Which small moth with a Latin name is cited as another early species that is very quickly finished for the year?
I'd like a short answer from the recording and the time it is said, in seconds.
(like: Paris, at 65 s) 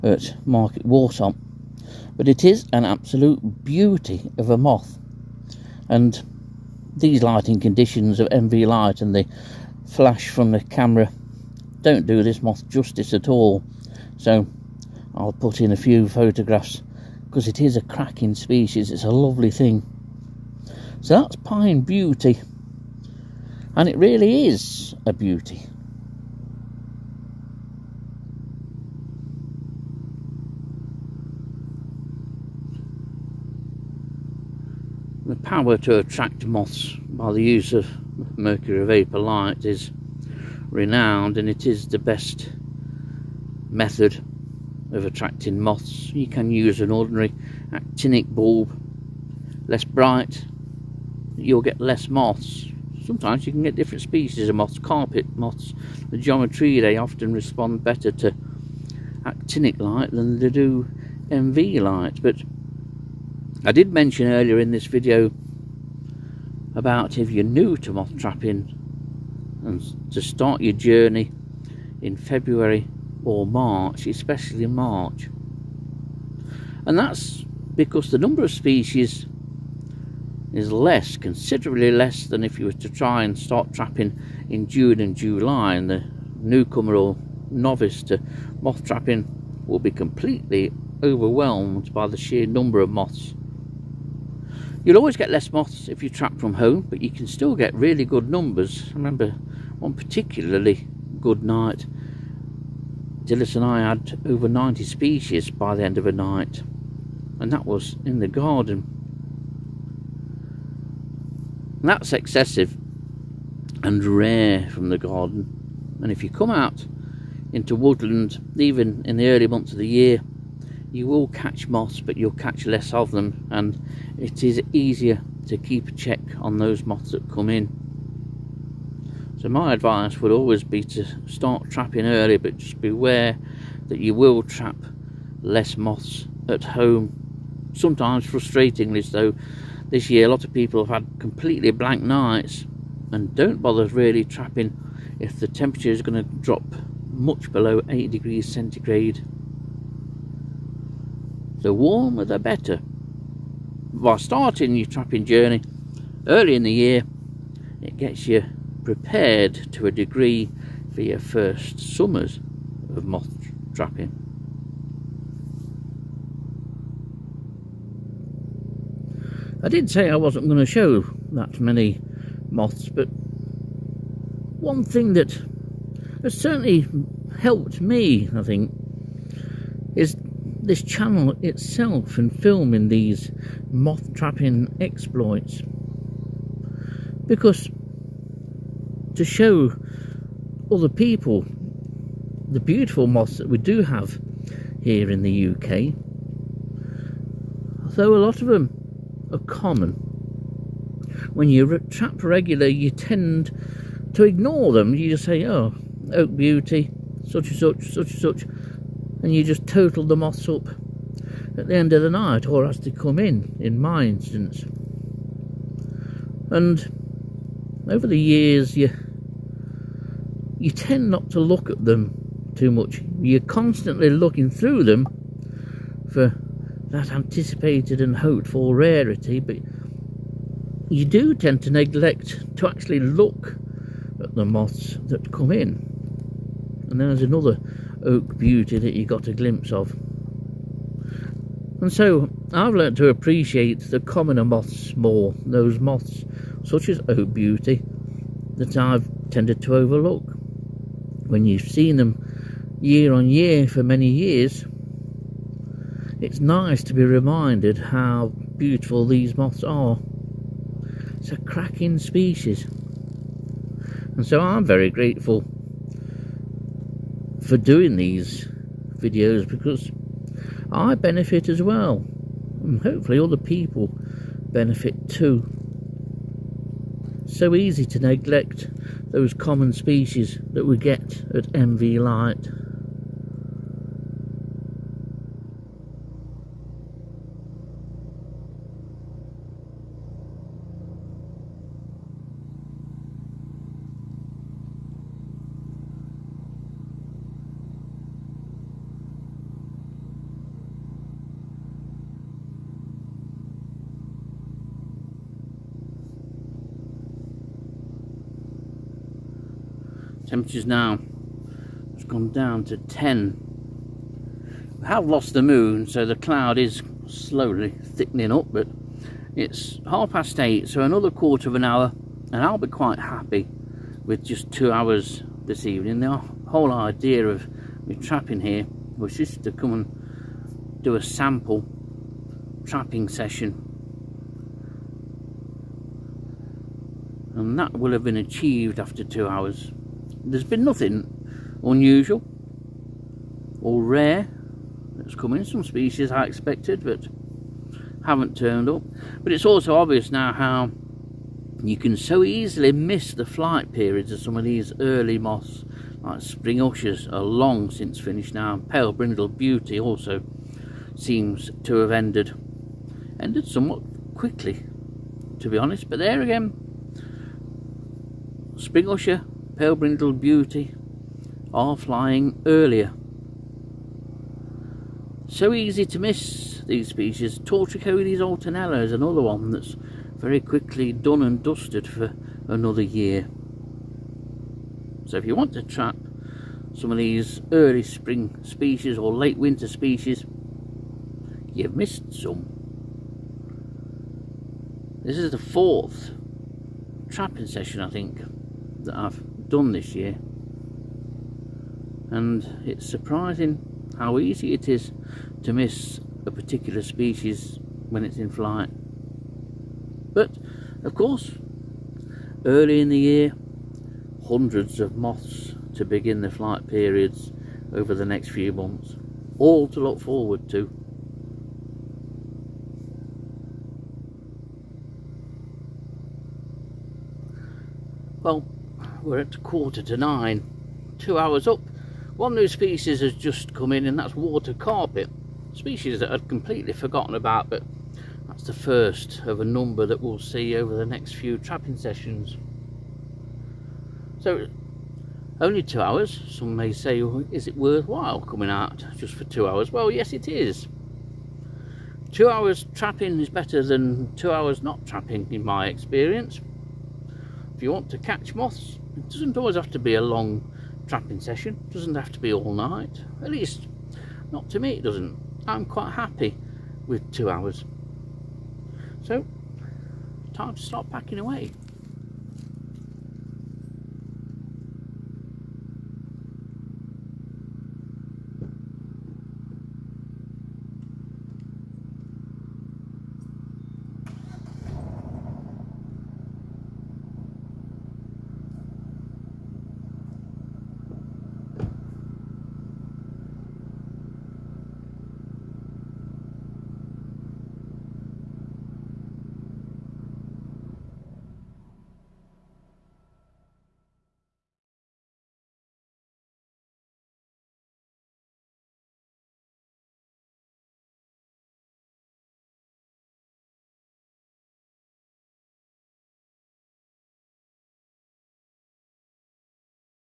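Tortricodes alternella, at 377 s.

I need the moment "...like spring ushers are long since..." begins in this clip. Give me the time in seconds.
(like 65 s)
356 s.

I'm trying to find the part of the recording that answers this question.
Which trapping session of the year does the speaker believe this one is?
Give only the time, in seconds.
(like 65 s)
395 s.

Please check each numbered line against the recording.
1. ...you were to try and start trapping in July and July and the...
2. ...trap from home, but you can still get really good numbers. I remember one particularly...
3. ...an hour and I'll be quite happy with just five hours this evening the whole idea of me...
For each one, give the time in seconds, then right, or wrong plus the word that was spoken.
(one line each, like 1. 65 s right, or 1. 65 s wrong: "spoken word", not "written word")
1. 82 s wrong: "June", not "July"
2. 96 s right
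3. 321 s wrong: "two", not "five".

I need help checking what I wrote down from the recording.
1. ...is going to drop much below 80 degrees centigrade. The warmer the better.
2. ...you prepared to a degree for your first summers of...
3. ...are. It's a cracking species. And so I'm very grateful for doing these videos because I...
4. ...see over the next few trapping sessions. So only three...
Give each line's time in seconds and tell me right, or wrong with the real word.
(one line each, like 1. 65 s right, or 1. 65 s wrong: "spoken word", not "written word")
1. 145 s right
2. 158 s right
3. 259 s right
4. 440 s wrong: "two", not "three".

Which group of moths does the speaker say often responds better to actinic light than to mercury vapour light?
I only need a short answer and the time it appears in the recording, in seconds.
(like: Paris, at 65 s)
Carpet moths, at 54 s.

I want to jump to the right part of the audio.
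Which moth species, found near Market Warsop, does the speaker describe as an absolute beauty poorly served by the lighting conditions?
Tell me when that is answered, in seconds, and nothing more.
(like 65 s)
21 s.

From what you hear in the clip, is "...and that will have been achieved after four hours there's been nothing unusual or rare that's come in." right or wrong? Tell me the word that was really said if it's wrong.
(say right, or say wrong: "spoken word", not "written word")
wrong: "two", not "four".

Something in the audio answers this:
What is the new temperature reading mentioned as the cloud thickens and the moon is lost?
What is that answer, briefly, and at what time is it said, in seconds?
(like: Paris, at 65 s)
10, at 312 s.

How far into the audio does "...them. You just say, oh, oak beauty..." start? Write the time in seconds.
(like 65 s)
204 s.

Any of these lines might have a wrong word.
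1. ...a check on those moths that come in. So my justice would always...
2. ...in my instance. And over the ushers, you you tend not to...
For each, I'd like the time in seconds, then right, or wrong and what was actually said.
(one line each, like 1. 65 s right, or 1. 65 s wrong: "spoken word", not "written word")
1. 125 s wrong: "advice", not "justice"
2. 213 s wrong: "years", not "ushers".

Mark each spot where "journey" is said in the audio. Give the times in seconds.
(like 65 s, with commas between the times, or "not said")
70 s, 155 s.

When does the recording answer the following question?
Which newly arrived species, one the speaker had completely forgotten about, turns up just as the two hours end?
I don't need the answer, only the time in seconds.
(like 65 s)
434 s.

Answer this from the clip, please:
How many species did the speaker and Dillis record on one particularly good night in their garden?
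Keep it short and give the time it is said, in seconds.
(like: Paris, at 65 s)
Over 90, at 104 s.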